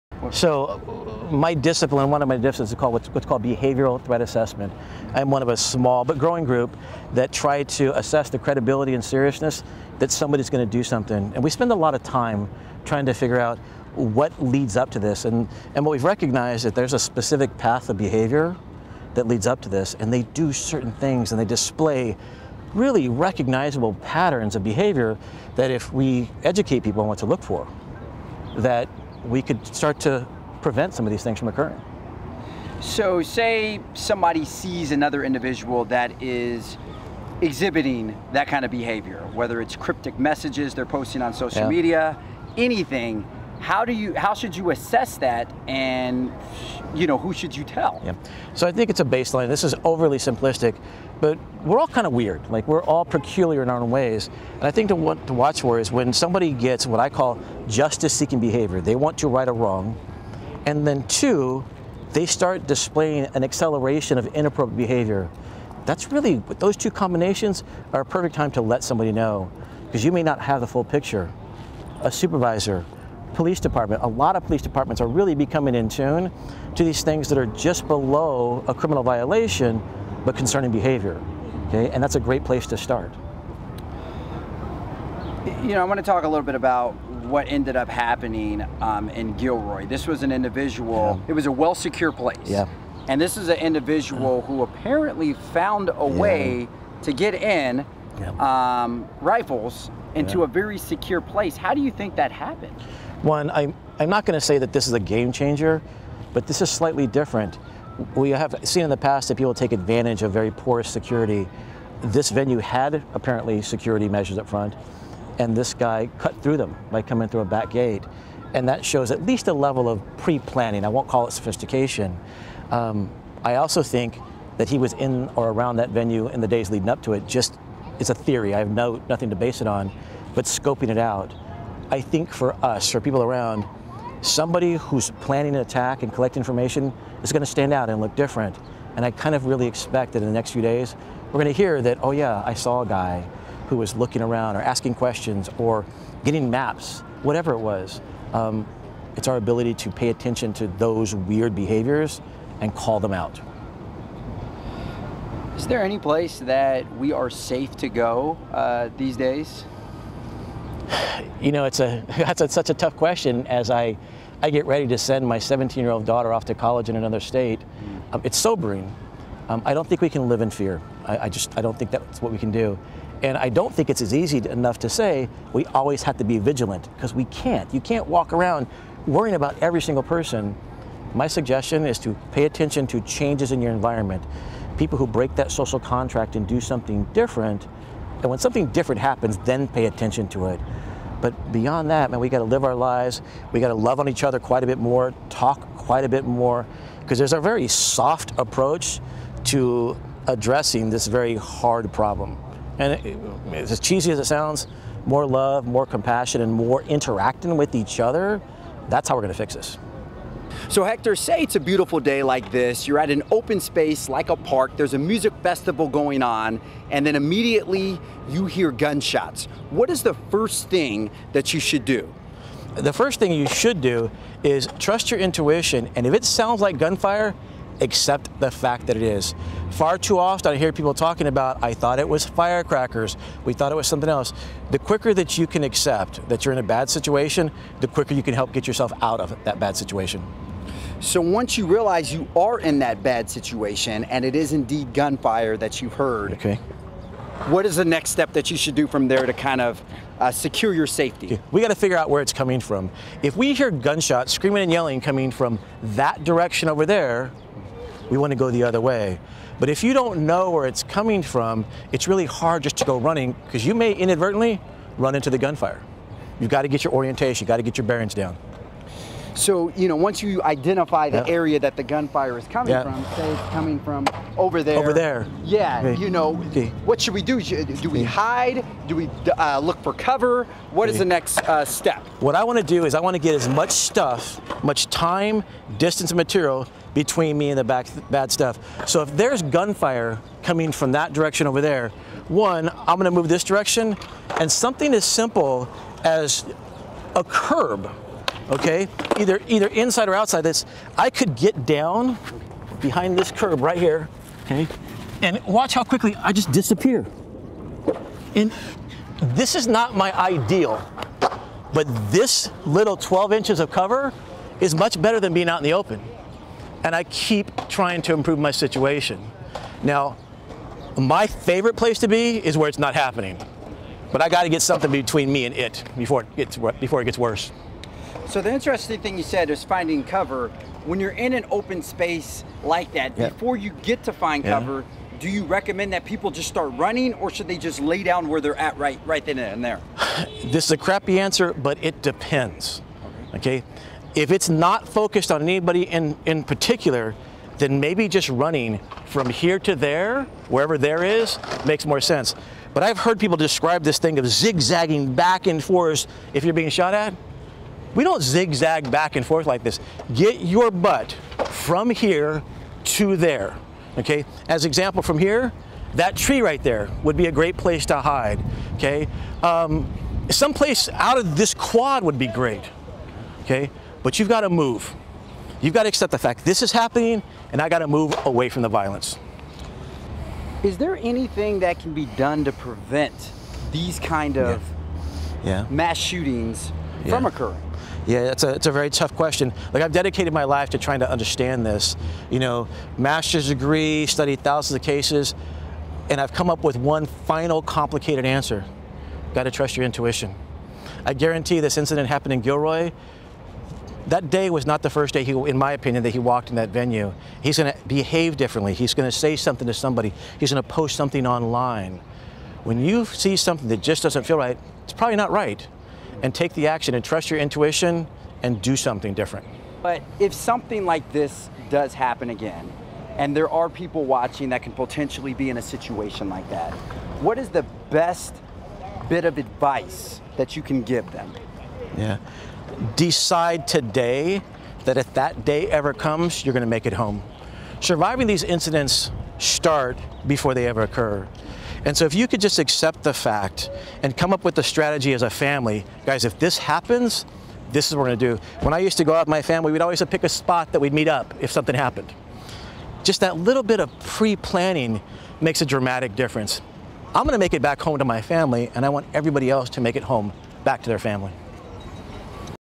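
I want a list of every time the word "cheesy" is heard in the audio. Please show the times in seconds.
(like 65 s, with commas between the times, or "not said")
203 s.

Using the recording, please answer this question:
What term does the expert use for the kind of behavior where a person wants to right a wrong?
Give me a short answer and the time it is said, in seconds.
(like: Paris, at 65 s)
Justice-seeking behavior, at 57 s.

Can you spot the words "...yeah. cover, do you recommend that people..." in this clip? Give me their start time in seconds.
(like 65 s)
334 s.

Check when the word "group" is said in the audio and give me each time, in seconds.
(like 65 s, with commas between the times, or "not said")
6 s.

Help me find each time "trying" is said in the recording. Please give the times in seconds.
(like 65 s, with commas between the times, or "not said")
12 s, 317 s, 390 s.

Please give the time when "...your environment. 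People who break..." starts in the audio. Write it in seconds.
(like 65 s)
183 s.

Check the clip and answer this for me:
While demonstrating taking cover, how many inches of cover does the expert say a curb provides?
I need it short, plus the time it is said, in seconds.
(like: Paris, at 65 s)
12 inches, at 312 s.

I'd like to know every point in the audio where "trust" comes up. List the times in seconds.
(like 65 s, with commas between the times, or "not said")
224 s, 399 s, 417 s.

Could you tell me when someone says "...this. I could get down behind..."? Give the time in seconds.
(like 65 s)
300 s.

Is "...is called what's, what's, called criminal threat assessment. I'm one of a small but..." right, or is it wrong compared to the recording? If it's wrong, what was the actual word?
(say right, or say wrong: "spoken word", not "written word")
wrong: "behavioral", not "criminal".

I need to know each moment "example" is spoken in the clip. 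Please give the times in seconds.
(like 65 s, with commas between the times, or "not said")
364 s.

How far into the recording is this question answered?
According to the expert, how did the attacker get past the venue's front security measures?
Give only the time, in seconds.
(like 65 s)
117 s.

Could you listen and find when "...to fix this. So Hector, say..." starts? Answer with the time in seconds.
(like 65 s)
209 s.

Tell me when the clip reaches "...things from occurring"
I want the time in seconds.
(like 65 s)
31 s.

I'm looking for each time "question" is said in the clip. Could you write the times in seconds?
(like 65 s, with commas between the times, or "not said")
144 s, 162 s, 389 s.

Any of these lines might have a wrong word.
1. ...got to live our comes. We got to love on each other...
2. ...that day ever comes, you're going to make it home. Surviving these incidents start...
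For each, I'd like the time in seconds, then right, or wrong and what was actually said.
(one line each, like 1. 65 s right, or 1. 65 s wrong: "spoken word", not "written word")
1. 192 s wrong: "lives", not "comes"
2. 435 s right.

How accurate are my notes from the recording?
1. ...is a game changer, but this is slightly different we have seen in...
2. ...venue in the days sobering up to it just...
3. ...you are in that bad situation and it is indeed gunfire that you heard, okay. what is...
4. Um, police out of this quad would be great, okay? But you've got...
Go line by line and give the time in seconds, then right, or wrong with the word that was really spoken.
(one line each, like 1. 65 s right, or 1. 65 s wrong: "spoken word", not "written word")
1. 104 s right
2. 125 s wrong: "leading", not "sobering"
3. 242 s right
4. 369 s wrong: "someplace", not "police".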